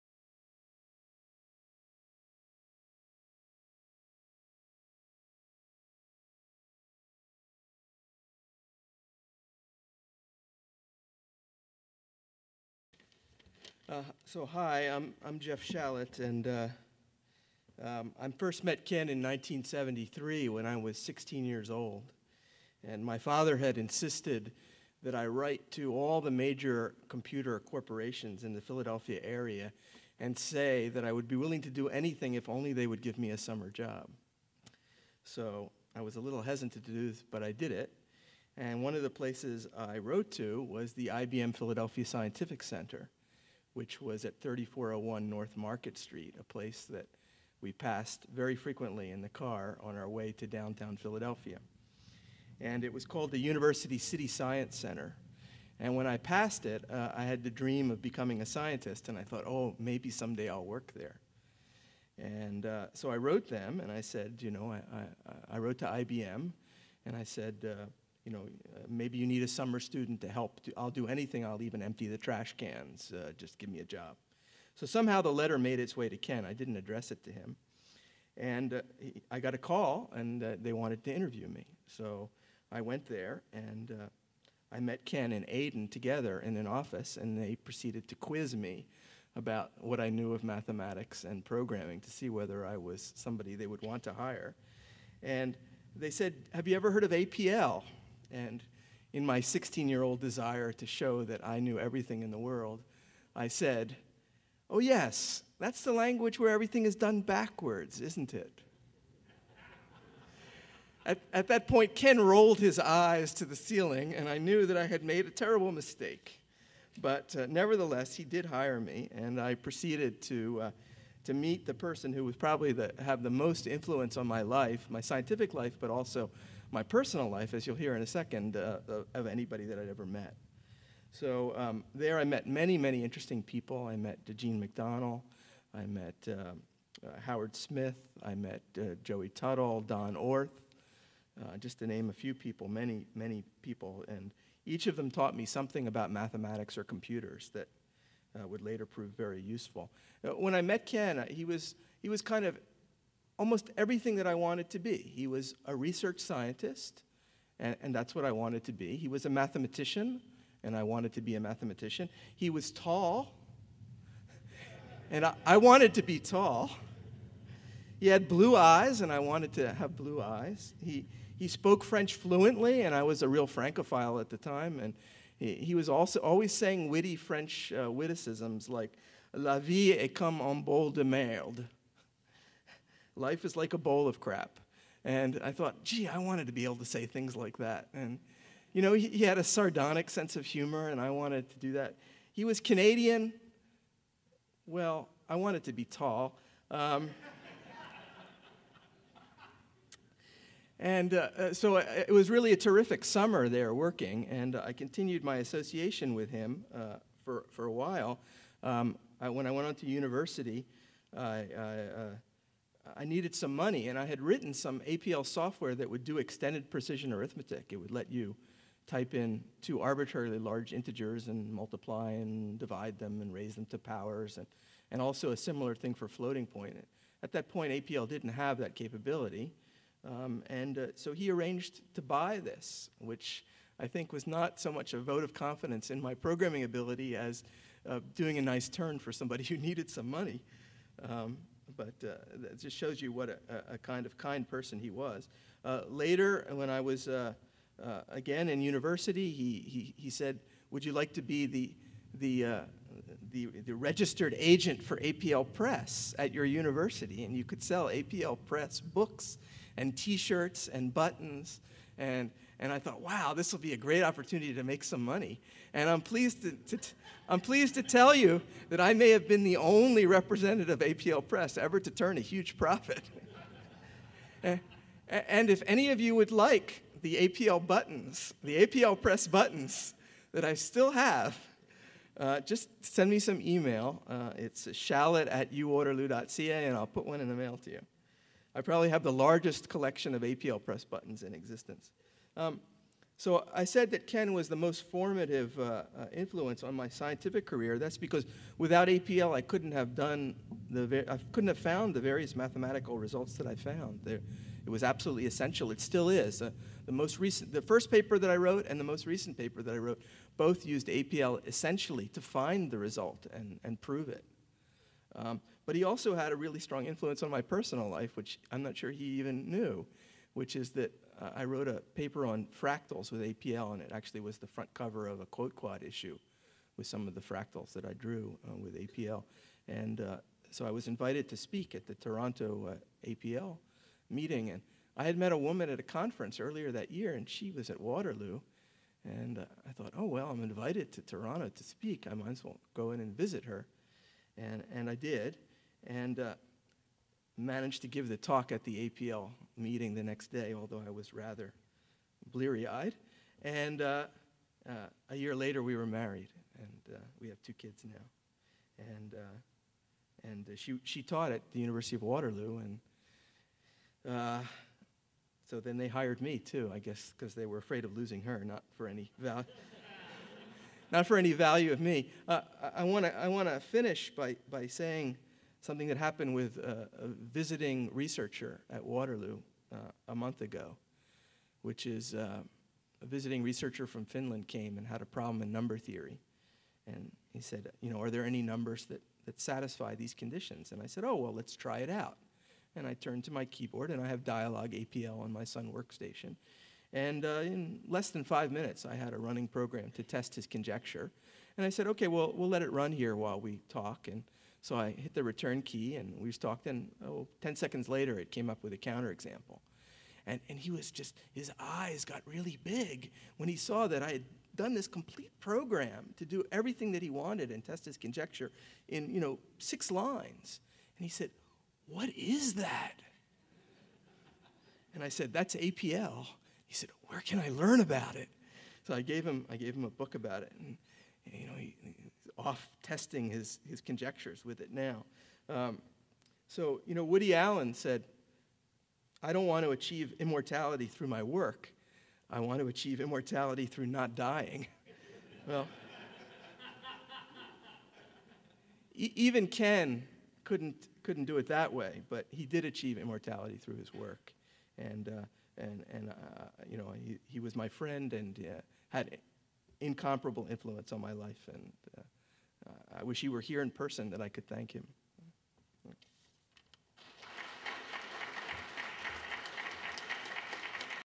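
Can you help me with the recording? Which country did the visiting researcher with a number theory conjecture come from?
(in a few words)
Finland.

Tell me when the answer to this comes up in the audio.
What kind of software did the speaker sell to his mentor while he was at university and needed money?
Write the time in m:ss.
3:36.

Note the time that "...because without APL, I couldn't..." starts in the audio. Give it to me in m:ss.
4:57.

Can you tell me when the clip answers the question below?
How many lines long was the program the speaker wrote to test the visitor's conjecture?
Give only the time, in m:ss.
6:59.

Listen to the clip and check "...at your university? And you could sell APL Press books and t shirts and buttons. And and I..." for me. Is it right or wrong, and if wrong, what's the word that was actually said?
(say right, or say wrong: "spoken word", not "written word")
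right.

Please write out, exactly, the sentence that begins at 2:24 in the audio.
And each of them taught me something about mathematics or computers that uh, would later prove very useful.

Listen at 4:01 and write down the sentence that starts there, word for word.
Um, but uh, that just shows you what a, a, kind of kind person he was.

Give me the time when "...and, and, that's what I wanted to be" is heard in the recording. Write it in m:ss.
2:37.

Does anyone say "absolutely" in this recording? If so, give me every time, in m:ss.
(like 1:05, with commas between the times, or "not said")
5:04.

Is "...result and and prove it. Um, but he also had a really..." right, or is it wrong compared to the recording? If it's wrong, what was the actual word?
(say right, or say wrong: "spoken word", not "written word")
right.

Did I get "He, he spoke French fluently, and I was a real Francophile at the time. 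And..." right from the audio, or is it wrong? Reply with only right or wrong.
right.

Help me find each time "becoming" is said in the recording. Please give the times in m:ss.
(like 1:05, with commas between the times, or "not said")
0:58.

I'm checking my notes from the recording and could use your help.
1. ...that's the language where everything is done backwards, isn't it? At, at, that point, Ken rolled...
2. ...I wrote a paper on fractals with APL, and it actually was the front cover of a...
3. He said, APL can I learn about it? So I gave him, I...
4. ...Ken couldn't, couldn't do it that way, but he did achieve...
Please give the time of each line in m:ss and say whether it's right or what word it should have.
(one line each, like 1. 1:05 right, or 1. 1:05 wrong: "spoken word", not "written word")
1. 1:45 right
2. 5:21 right
3. 7:06 wrong: "Where", not "APL"
4. 7:29 right.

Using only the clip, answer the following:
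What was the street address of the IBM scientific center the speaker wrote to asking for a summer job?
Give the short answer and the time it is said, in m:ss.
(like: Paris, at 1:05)
3401 North Market Street, at 0:44.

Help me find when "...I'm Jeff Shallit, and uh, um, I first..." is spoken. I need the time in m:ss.
0:15.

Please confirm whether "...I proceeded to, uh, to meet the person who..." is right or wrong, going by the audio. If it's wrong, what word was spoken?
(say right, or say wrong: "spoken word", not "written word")
right.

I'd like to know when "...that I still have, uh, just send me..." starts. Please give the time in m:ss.
4:40.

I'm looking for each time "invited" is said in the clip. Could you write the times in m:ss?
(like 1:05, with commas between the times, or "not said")
5:30, 5:40.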